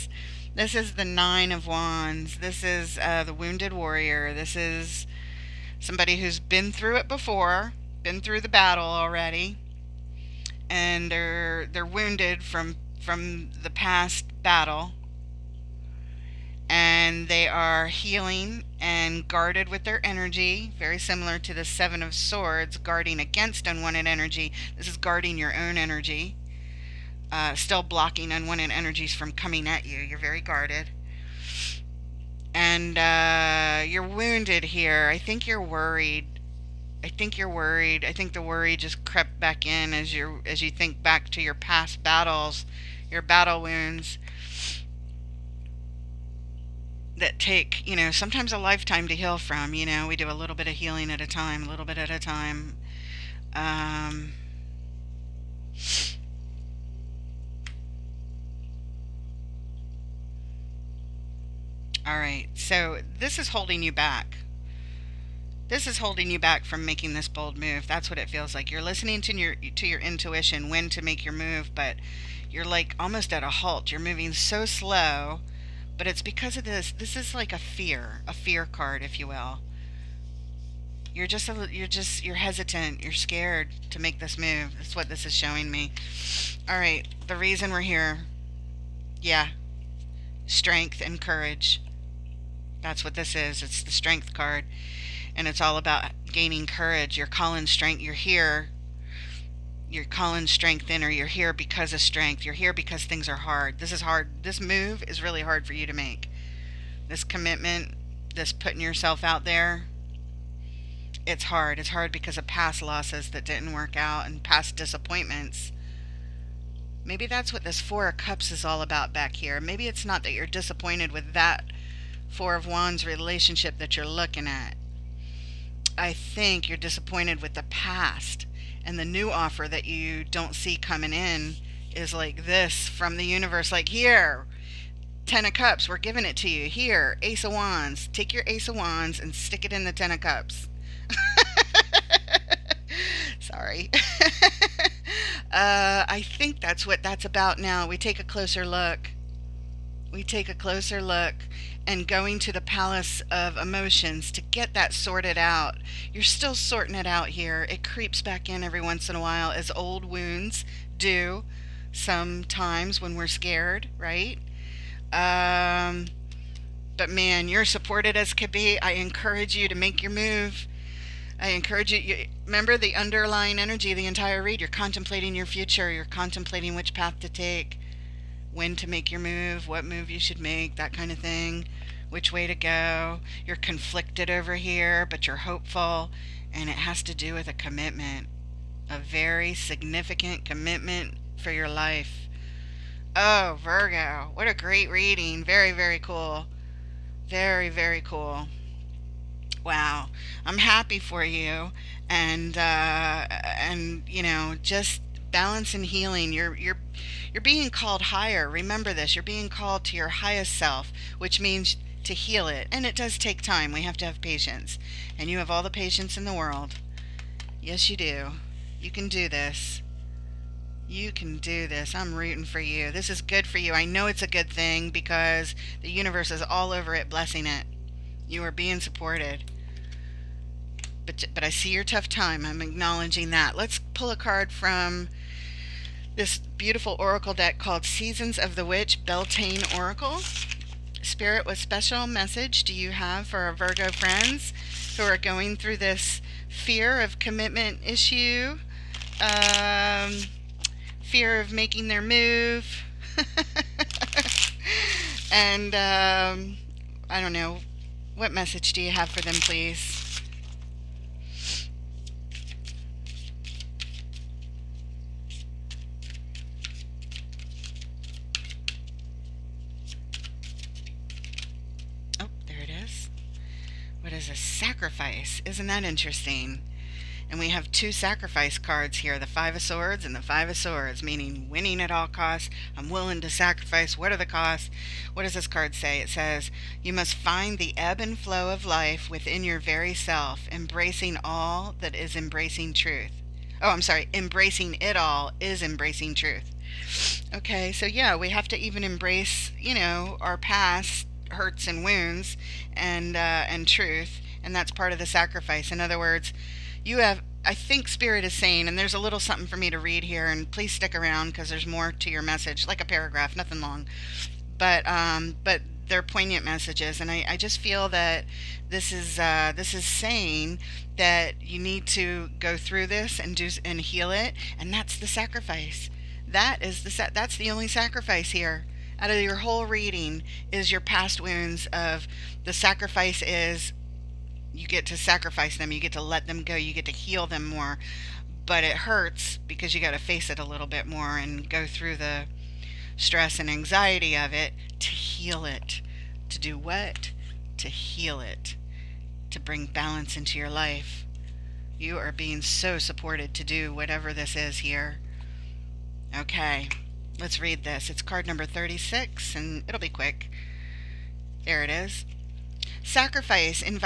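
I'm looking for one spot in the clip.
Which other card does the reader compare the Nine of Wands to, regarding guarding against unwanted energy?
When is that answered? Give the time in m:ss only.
0:21.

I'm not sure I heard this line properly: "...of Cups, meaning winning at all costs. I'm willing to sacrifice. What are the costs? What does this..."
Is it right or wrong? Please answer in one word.
wrong.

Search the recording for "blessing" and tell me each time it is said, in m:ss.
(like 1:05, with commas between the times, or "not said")
3:47.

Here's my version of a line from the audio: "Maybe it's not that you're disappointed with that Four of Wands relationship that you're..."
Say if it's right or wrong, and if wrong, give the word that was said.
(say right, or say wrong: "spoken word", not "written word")
right.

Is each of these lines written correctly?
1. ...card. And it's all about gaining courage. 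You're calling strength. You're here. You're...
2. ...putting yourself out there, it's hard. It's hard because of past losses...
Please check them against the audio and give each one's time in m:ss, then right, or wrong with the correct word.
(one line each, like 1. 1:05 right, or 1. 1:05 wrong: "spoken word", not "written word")
1. 1:34 right
2. 1:48 right.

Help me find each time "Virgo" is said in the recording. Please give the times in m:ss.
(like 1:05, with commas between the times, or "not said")
3:13, 4:03.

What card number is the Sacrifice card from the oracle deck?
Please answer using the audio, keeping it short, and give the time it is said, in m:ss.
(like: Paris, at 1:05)
36, at 5:58.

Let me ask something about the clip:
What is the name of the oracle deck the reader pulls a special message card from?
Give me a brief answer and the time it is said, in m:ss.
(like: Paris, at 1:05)
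Seasons of the Witch Beltane Oracle, at 3:57.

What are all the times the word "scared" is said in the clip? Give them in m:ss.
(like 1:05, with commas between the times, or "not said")
1:23, 2:43.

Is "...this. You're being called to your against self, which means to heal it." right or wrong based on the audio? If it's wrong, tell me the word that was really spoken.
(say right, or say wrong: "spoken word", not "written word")
wrong: "highest", not "against".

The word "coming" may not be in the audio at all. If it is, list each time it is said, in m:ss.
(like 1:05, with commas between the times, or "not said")
0:29, 2:10.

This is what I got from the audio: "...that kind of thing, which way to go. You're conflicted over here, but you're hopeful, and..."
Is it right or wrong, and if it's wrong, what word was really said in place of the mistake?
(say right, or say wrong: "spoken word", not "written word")
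right.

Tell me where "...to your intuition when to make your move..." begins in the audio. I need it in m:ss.
1:09.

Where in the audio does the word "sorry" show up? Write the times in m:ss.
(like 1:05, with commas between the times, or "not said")
2:23, 4:53.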